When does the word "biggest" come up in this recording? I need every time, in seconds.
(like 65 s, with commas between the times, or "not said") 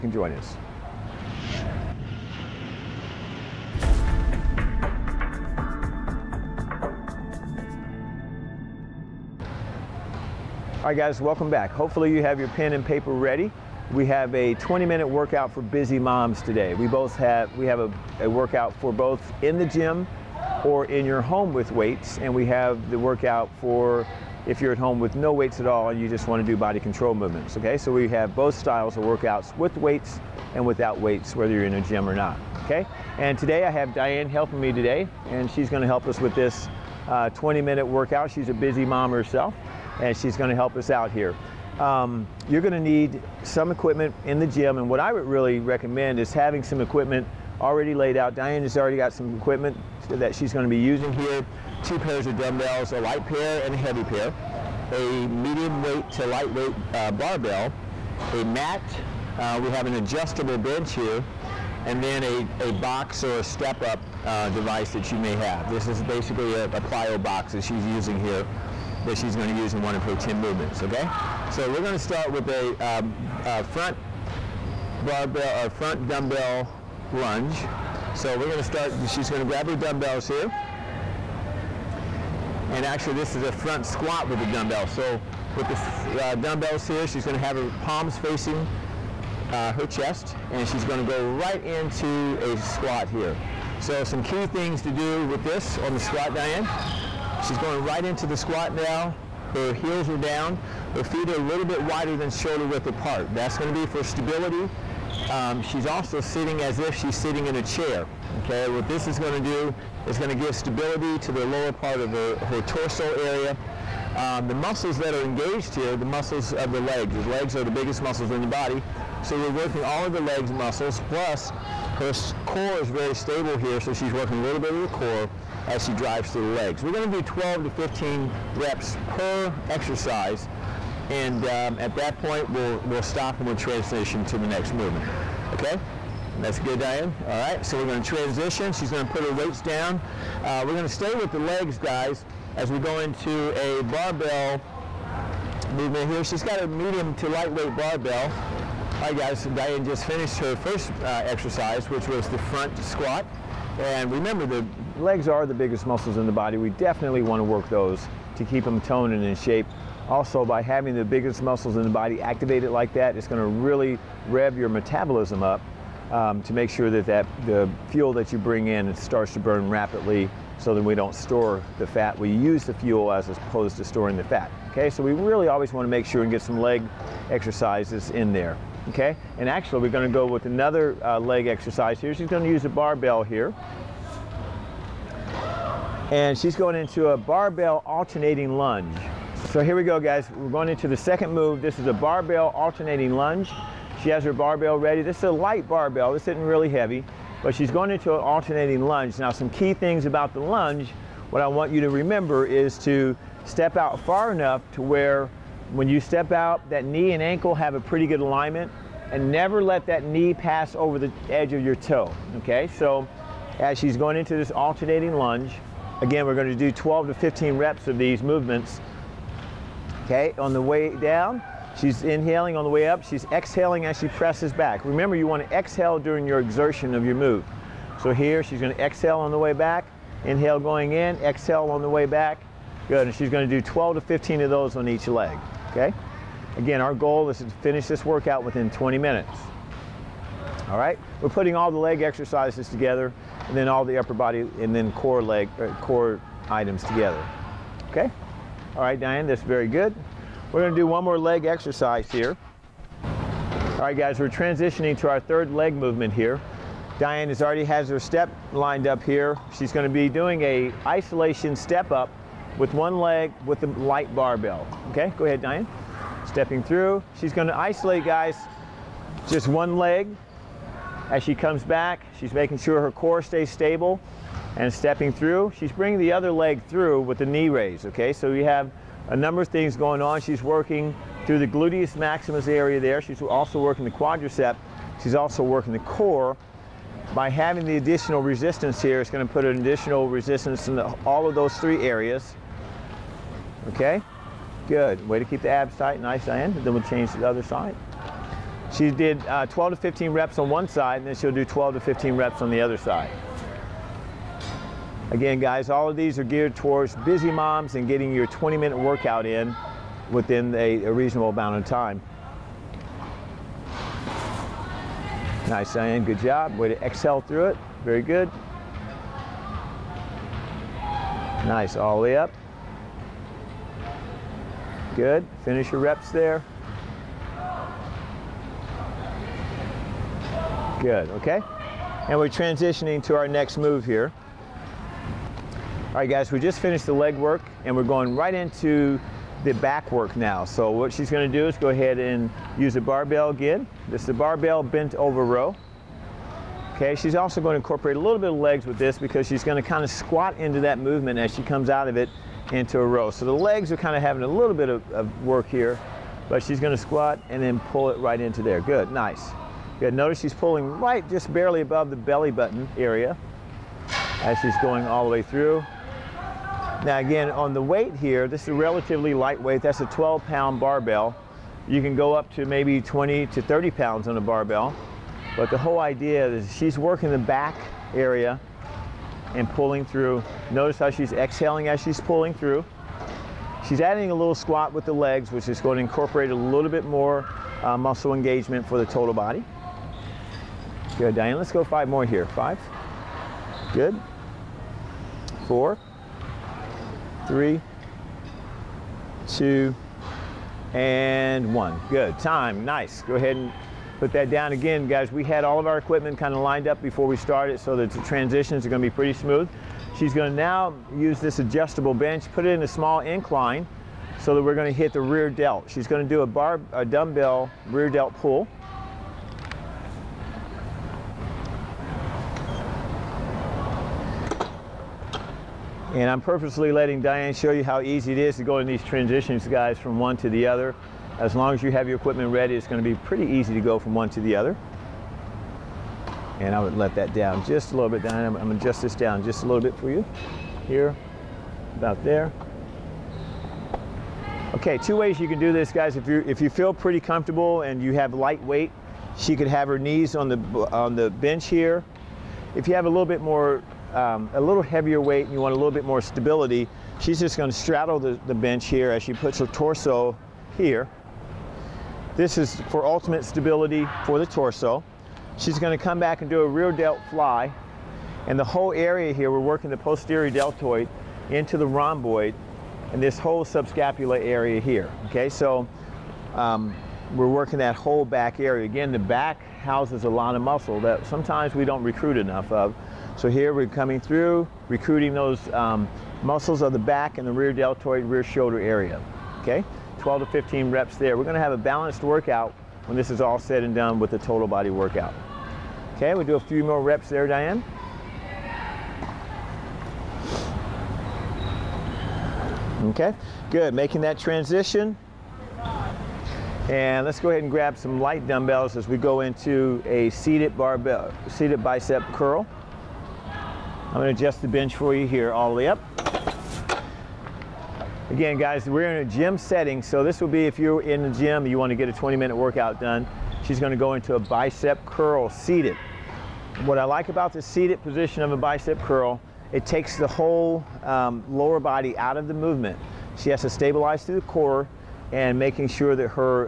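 117 s, 155 s, 161 s.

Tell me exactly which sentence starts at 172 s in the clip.
We use the fuel as opposed to storing the fat.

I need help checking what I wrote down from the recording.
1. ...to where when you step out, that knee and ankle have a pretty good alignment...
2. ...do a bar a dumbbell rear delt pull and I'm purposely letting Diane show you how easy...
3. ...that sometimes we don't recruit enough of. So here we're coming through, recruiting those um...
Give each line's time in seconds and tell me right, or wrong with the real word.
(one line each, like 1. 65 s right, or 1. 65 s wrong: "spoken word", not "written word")
1. 204 s right
2. 416 s right
3. 480 s right.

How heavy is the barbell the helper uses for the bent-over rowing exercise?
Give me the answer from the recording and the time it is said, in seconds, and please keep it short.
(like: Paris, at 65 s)
12 pounds, at 369 s.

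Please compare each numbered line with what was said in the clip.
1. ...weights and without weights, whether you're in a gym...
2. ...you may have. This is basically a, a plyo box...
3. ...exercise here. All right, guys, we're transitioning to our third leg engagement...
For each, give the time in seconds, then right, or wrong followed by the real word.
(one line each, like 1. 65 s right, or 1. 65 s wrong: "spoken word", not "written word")
1. 29 s right
2. 65 s right
3. 251 s wrong: "movement", not "engagement".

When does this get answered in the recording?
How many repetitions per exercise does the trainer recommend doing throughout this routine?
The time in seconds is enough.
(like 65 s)
127 s.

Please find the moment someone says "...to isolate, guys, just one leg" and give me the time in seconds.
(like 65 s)
267 s.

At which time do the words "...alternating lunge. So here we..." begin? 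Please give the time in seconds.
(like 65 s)
187 s.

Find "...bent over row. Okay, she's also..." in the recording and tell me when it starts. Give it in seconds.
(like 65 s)
344 s.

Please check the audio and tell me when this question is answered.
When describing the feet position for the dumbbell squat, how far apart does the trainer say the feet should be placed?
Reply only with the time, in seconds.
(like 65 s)
101 s.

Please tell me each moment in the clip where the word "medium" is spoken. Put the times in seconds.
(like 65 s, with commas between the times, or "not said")
55 s, 146 s.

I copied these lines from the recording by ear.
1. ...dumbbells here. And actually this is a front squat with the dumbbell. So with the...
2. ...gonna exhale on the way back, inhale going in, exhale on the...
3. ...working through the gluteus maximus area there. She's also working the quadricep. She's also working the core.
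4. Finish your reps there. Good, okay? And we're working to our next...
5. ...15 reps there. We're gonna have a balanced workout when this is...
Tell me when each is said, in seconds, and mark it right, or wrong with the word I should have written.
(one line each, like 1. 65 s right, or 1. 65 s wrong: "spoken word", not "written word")
1. 79 s right
2. 228 s right
3. 280 s right
4. 325 s wrong: "transitioning", not "working"
5. 490 s right.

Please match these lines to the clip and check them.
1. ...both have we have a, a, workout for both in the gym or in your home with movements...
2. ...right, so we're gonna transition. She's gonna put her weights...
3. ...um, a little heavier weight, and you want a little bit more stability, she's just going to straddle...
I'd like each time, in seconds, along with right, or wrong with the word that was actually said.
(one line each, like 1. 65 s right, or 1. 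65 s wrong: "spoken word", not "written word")
1. 16 s wrong: "weights", not "movements"
2. 137 s right
3. 453 s right.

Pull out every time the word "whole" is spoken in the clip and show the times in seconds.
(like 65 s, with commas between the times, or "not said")
375 s, 468 s, 473 s, 477 s, 530 s.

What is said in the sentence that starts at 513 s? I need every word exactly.
I'm gonna adjust the bench for you here all the way up.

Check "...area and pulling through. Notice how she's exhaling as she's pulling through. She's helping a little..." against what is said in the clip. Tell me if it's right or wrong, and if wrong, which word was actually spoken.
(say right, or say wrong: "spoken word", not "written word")
wrong: "adding", not "helping".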